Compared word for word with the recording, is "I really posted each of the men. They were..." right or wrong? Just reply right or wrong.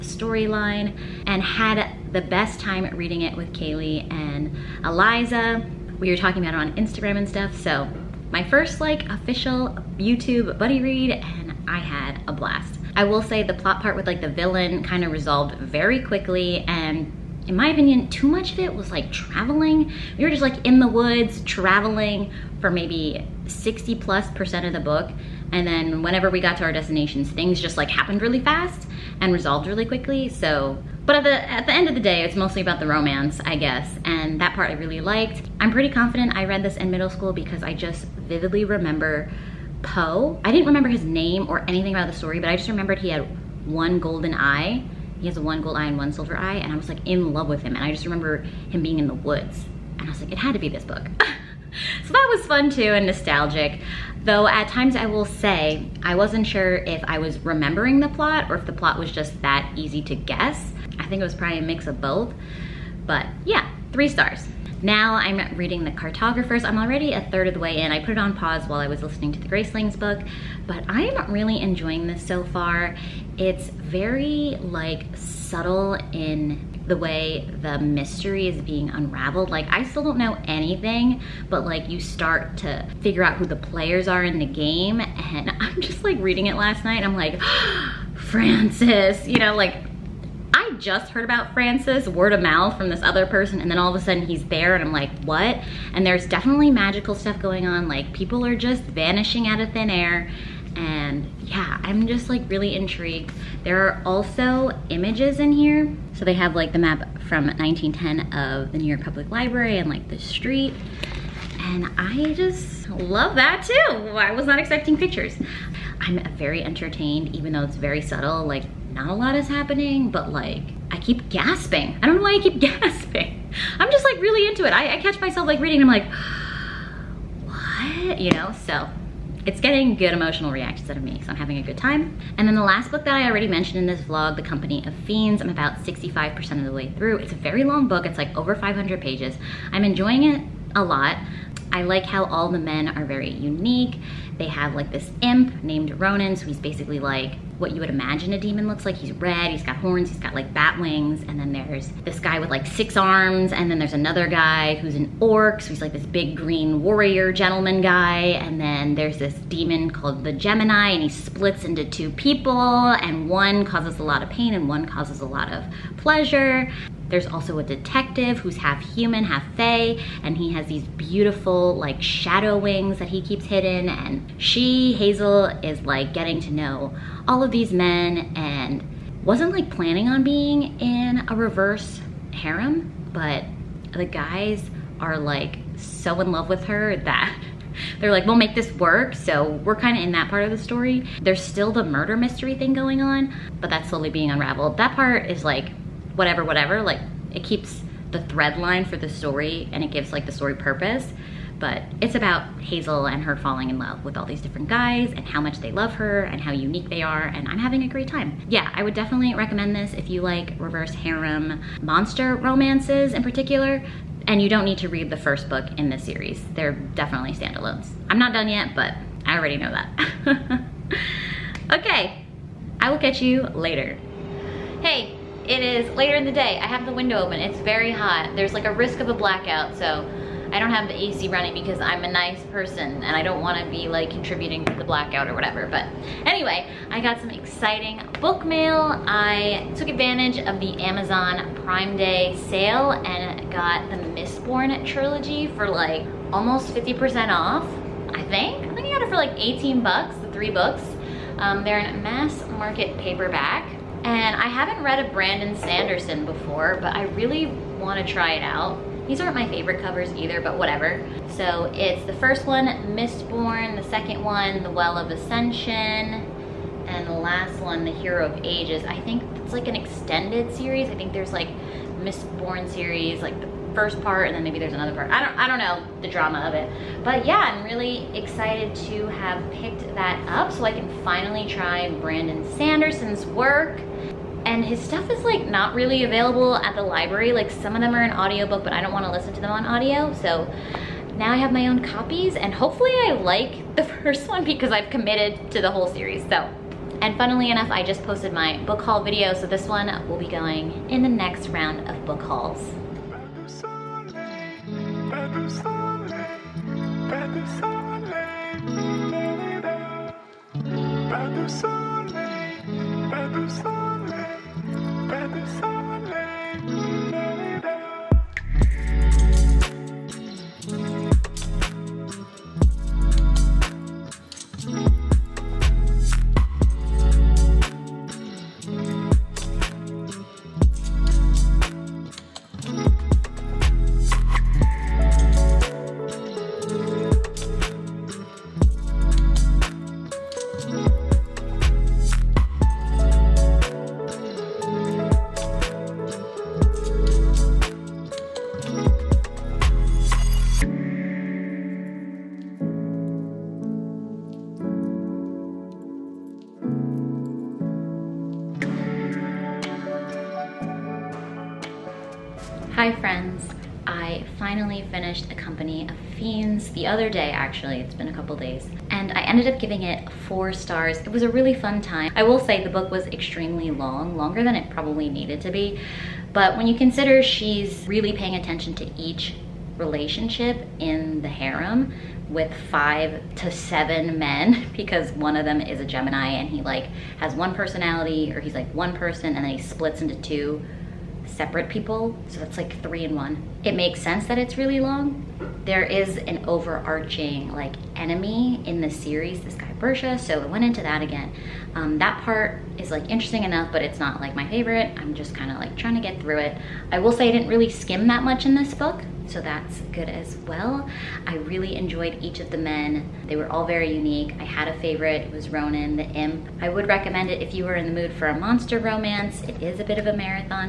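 wrong.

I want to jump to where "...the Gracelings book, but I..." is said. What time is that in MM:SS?
01:09.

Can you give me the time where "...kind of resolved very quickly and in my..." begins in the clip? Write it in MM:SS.
00:14.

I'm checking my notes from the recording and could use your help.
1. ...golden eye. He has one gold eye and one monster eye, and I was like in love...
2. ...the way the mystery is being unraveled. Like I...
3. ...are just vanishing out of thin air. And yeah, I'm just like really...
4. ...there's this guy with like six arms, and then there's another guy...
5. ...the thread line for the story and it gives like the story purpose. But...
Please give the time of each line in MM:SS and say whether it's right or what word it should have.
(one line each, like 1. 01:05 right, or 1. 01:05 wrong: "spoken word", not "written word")
1. 00:43 wrong: "silver", not "monster"
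2. 01:16 right
3. 01:38 right
4. 02:31 right
5. 03:18 right.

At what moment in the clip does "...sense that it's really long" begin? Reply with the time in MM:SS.
06:34.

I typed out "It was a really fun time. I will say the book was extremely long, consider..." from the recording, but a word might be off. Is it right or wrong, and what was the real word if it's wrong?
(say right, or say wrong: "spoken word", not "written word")
wrong: "longer", not "consider".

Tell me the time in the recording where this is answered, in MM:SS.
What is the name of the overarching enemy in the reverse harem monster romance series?
06:39.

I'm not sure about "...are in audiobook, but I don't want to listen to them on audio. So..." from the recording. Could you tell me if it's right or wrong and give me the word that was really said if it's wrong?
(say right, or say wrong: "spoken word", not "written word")
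right.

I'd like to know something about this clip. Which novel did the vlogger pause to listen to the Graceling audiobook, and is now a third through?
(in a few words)
The Cartographers.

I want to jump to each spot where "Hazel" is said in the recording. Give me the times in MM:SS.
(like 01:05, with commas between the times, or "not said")
02:54, 03:22.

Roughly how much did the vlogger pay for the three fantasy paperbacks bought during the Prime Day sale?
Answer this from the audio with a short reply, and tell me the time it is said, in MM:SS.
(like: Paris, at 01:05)
18 bucks, at 04:09.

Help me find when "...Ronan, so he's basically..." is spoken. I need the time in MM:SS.
02:25.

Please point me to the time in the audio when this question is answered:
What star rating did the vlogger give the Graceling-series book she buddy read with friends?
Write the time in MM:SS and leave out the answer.
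01:03.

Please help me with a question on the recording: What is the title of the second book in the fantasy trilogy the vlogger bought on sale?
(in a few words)
The Well of Ascension.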